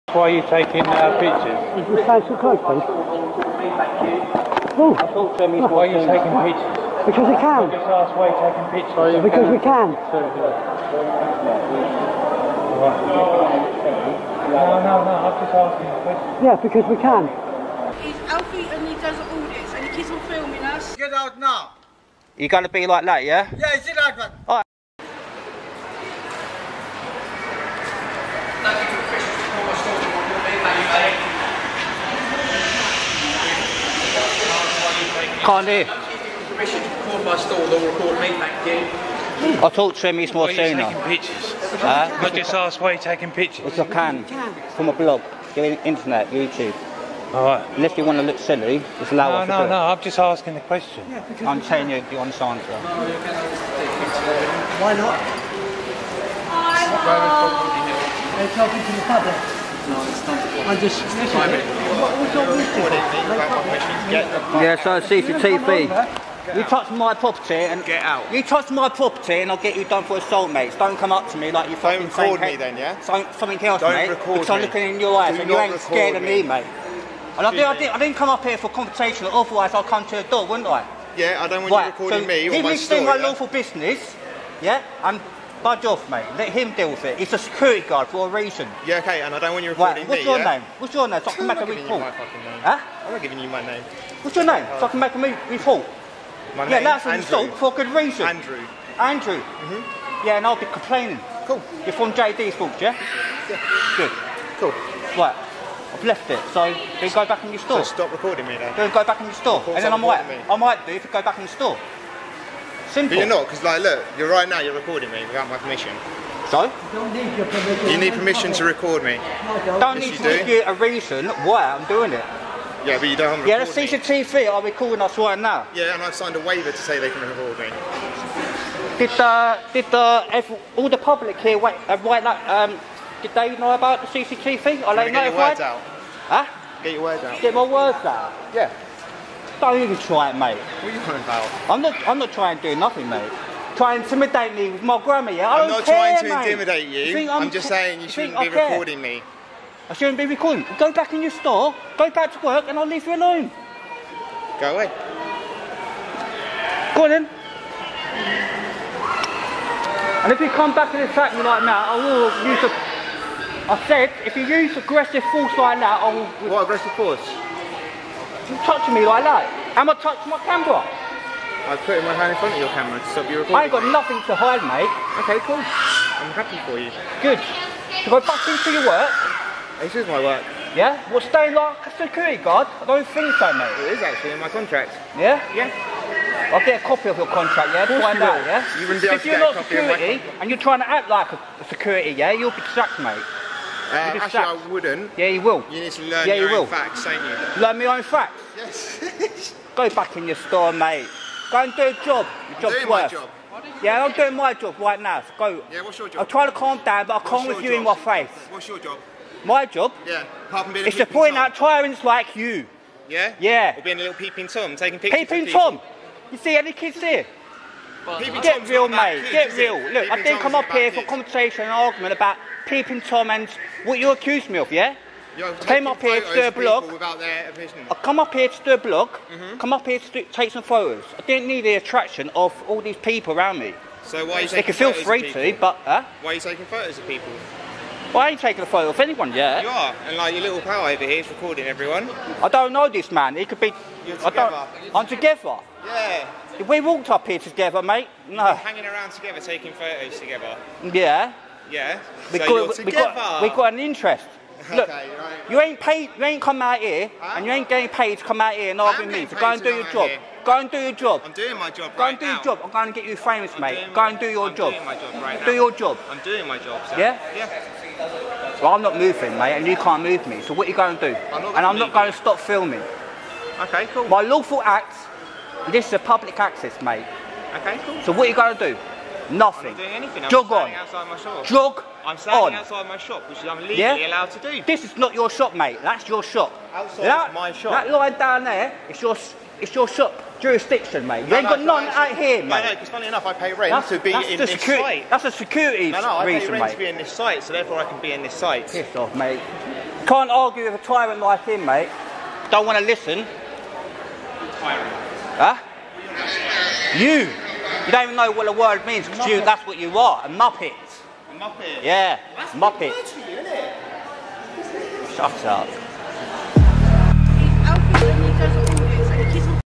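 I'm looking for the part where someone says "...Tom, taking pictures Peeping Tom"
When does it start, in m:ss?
3:34.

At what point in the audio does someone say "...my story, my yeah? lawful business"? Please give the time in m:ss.
1:22.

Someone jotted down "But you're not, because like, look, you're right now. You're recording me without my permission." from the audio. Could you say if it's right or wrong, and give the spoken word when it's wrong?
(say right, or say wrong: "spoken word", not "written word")
right.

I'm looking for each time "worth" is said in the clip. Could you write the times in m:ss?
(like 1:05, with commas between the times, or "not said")
3:22.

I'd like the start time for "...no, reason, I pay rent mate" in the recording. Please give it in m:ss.
4:56.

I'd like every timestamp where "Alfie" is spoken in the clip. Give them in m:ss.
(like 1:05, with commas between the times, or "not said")
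0:18.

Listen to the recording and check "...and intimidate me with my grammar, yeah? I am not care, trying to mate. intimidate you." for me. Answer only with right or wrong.
right.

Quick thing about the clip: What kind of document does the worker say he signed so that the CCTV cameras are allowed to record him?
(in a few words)
waiver.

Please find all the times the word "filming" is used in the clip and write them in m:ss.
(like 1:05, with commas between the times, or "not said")
0:20, 4:32.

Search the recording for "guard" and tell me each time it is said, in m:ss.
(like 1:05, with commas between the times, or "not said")
1:27, 3:02.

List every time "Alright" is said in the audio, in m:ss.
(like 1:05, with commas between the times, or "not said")
0:47.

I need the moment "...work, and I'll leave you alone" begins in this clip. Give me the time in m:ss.
2:32.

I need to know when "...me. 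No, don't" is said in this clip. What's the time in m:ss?
1:59.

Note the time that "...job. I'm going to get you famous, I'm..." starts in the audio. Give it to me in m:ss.
4:22.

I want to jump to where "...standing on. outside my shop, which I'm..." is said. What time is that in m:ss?
4:42.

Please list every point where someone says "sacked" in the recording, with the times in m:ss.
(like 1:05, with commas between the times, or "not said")
3:12.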